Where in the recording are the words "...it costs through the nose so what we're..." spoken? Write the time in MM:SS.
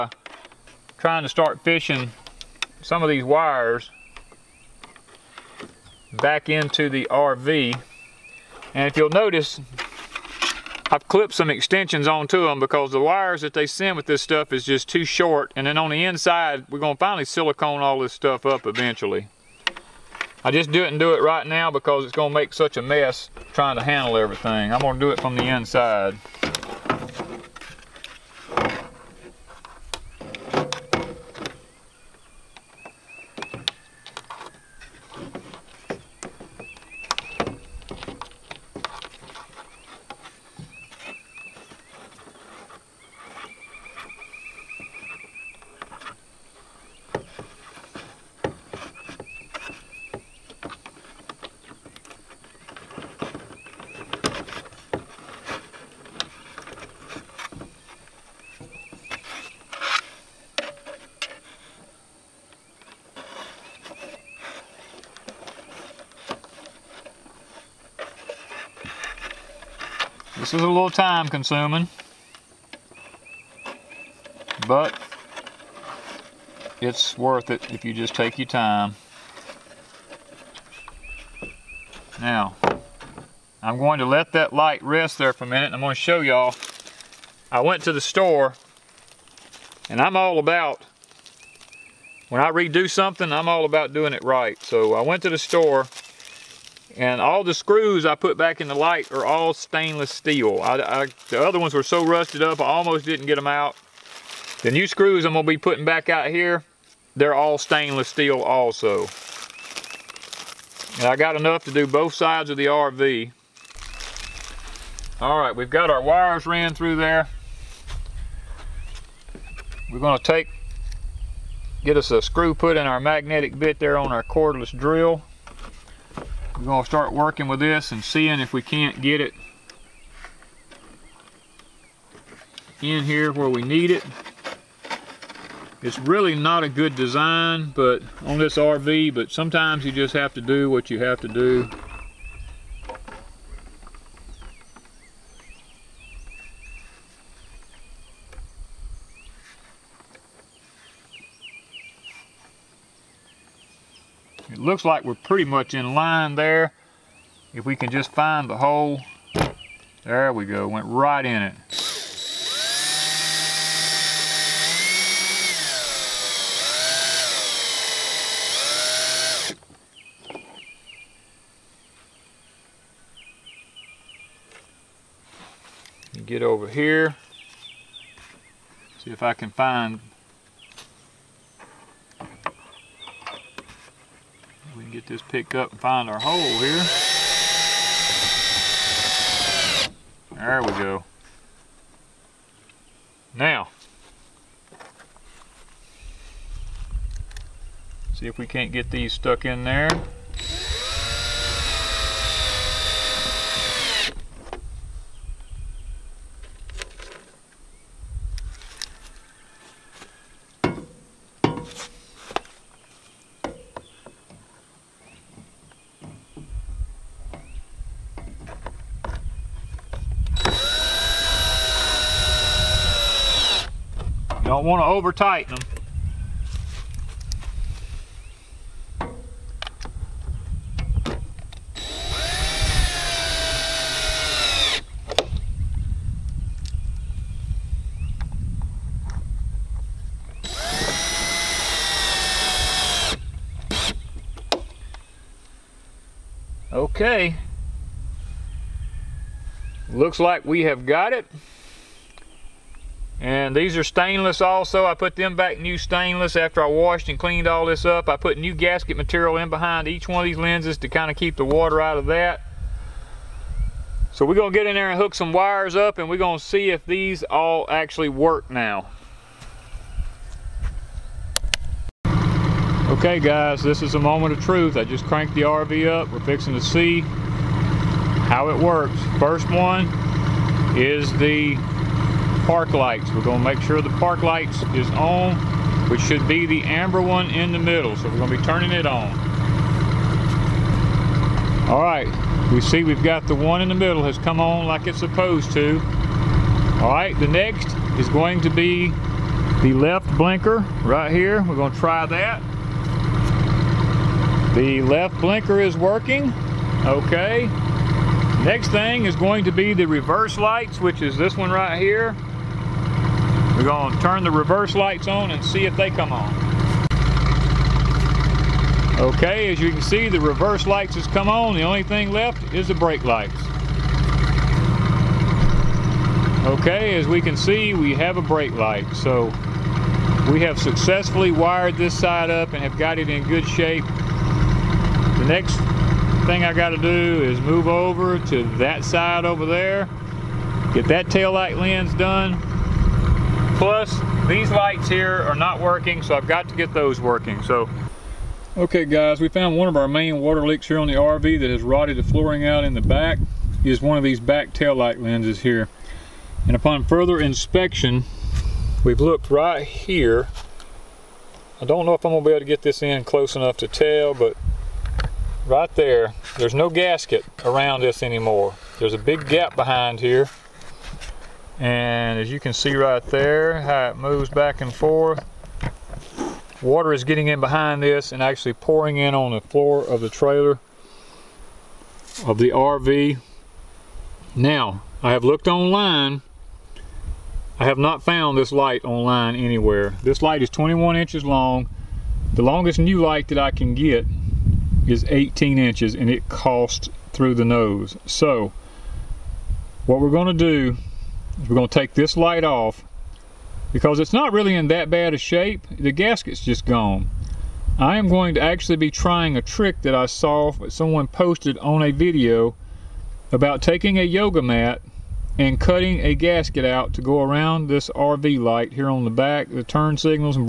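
06:36.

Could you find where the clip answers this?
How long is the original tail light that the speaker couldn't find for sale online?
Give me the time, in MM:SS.
06:30.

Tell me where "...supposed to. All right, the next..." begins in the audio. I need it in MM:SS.
04:54.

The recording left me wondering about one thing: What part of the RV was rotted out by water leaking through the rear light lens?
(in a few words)
flooring.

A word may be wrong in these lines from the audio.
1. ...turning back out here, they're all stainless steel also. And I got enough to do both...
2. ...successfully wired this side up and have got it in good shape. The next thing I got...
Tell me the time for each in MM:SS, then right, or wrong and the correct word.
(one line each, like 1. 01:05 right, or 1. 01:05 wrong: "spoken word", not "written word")
1. 01:45 wrong: "putting", not "turning"
2. 05:30 right.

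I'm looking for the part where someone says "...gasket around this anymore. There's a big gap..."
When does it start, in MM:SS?
06:06.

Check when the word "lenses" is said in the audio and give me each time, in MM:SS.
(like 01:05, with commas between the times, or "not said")
04:20, 05:54.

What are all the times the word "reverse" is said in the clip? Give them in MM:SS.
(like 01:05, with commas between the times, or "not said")
05:09, 05:14, 05:20.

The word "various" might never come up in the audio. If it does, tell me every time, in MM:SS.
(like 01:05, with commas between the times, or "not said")
not said.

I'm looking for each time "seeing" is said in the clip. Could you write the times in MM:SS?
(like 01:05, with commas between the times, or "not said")
02:08.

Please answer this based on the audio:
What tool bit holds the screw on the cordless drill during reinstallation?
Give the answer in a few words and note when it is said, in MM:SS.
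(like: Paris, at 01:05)
magnetic bit, at 02:03.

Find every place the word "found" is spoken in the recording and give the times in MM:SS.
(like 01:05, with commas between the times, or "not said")
05:49, 06:28.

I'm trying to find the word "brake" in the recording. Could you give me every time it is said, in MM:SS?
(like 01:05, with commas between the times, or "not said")
05:22, 05:28.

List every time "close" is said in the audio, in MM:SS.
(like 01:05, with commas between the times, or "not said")
06:03.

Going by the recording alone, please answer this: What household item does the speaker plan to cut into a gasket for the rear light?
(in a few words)
yoga mat.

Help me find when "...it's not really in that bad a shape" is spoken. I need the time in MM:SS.
06:43.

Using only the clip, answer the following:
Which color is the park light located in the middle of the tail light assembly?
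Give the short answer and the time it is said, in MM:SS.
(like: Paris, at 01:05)
amber, at 04:46.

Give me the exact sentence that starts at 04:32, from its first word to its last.
Okay guys, this is a moment of truth.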